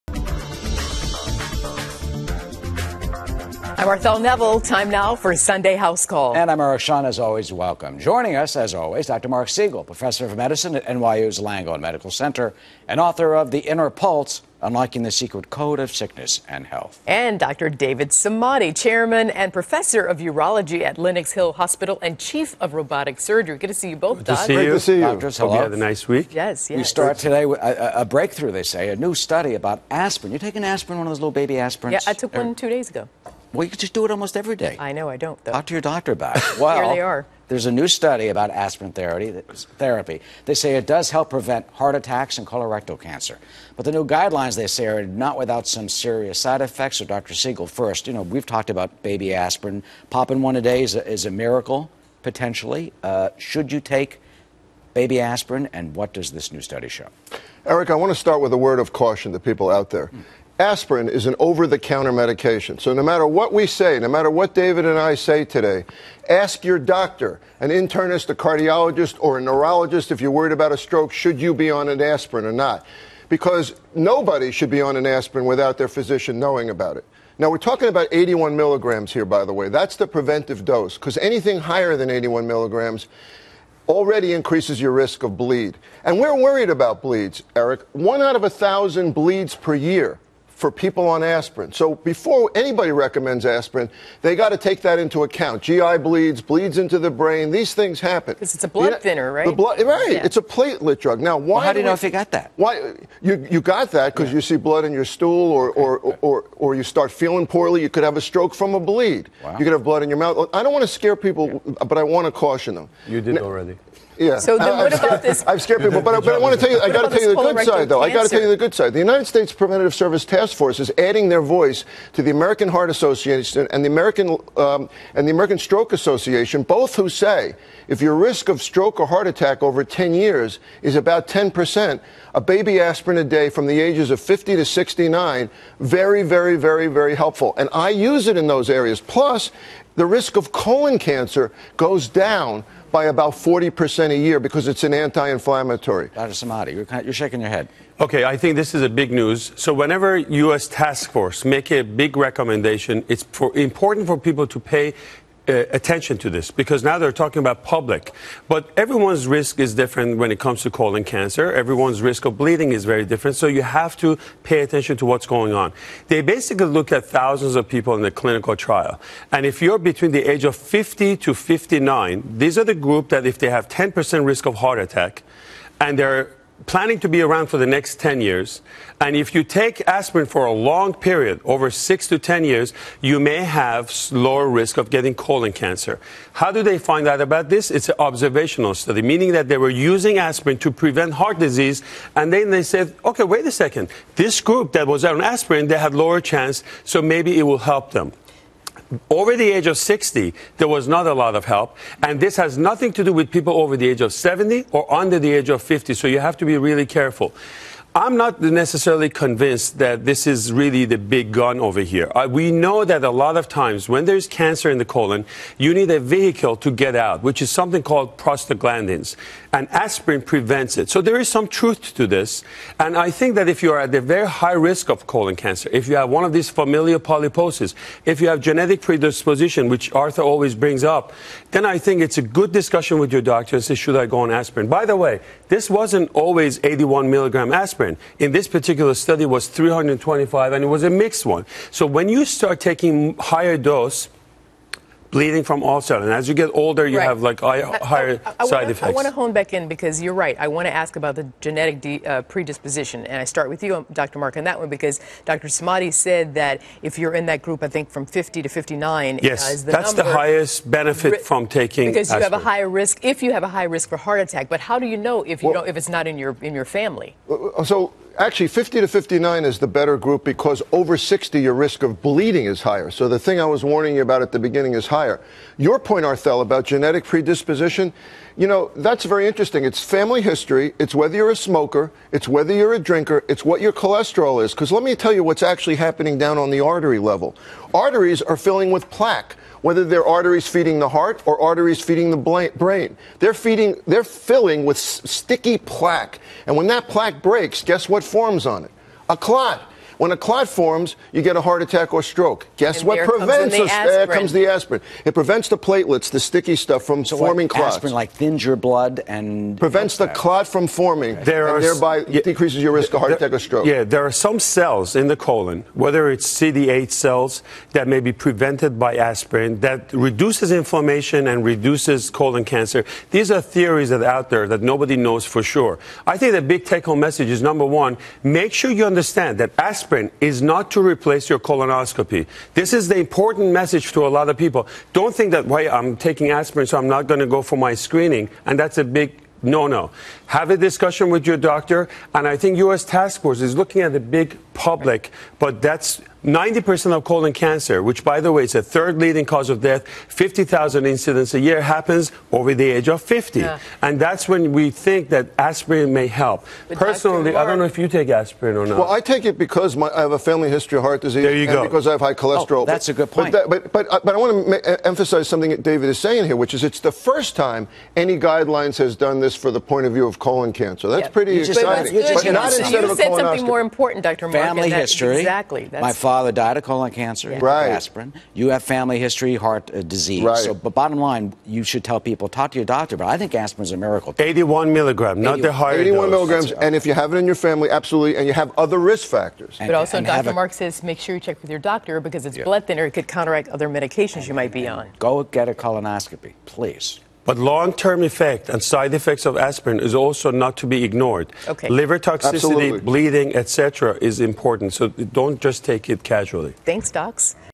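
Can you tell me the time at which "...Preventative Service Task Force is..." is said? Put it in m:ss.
1:59.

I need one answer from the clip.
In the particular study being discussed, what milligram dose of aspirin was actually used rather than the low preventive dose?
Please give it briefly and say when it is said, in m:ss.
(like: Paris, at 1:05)
325, at 3:59.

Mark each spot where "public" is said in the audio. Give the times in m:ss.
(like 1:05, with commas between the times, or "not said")
2:37, 5:44.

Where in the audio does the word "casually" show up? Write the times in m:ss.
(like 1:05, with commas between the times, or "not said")
6:46.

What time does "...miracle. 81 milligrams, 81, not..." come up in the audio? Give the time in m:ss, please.
6:23.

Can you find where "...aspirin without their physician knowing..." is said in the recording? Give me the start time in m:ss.
1:15.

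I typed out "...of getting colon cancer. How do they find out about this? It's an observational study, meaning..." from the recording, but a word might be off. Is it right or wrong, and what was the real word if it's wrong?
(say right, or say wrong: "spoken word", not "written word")
right.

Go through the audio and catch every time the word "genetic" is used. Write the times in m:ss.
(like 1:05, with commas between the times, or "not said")
3:48, 4:11, 4:36.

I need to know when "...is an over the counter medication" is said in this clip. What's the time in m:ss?
1:01.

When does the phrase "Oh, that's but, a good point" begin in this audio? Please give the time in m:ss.
6:02.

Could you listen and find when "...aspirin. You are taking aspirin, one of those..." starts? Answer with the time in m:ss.
0:29.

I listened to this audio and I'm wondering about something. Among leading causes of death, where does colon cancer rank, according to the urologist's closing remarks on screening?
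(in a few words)
third.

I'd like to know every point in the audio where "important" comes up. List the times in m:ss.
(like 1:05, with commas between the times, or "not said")
2:33, 5:32, 6:13, 6:44.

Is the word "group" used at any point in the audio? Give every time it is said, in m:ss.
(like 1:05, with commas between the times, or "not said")
2:52, 3:14, 4:17, 4:29.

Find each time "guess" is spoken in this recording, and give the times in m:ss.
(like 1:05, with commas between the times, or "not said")
4:57, 5:02.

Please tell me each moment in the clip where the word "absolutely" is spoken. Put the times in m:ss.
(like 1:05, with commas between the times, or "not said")
6:27, 6:42.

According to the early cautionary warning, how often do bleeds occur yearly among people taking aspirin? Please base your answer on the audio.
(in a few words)
1 out of 1,000.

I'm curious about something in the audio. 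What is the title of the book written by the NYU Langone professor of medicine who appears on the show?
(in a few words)
The Inner Pulse.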